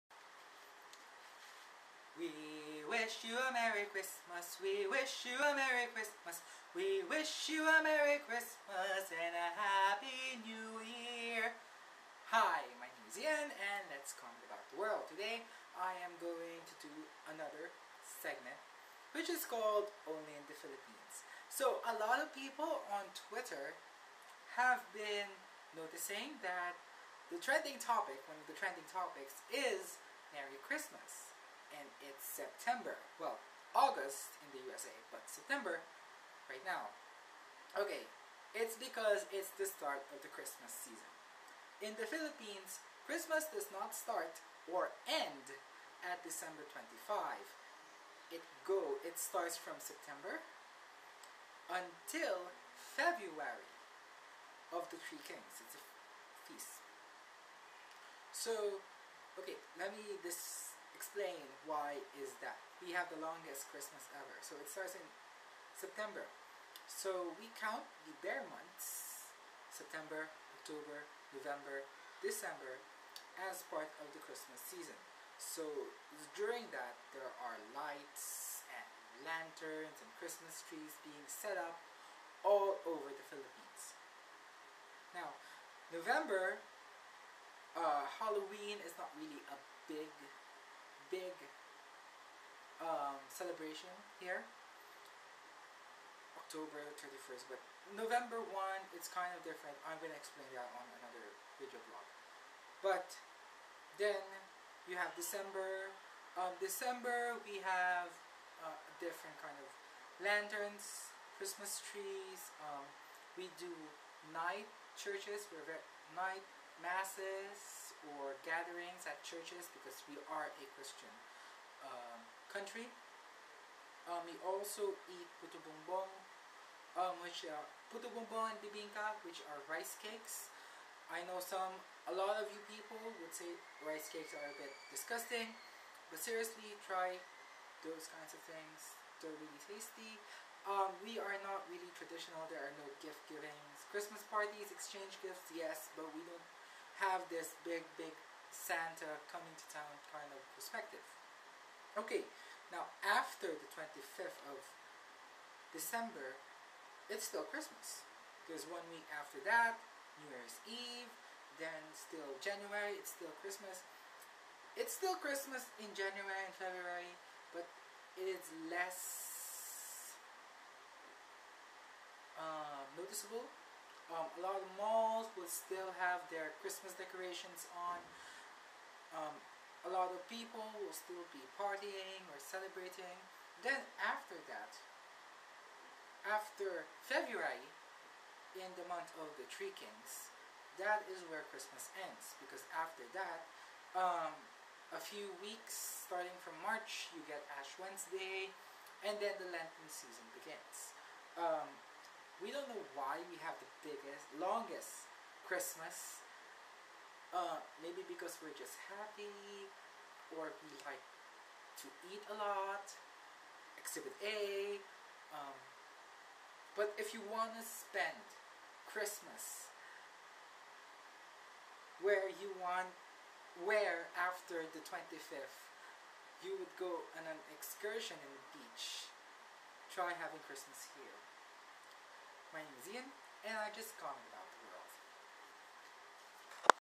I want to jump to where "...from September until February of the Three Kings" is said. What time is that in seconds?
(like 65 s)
49 s.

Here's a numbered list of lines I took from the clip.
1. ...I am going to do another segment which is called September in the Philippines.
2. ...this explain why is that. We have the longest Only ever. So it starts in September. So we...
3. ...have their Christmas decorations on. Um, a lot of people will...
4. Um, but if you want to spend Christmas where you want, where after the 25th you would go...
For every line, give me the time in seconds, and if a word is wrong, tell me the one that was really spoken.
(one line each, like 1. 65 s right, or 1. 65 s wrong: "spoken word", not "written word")
1. 15 s wrong: "Only", not "September"
2. 60 s wrong: "Christmas", not "Only"
3. 176 s right
4. 215 s right.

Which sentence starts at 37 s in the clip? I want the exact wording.
Okay, it's because it's the start of the Christmas season.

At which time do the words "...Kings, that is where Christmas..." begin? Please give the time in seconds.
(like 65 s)
189 s.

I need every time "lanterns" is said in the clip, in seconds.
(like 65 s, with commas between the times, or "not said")
79 s, 110 s.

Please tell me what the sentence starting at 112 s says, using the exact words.
Um, we do night churches, we're night masses, or gatherings at churches because we are a Christian um, country.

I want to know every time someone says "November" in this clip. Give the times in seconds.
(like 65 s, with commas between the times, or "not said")
71 s, 85 s, 97 s.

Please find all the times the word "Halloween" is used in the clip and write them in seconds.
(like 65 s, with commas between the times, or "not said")
88 s.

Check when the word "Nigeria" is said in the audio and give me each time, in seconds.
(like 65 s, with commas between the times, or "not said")
not said.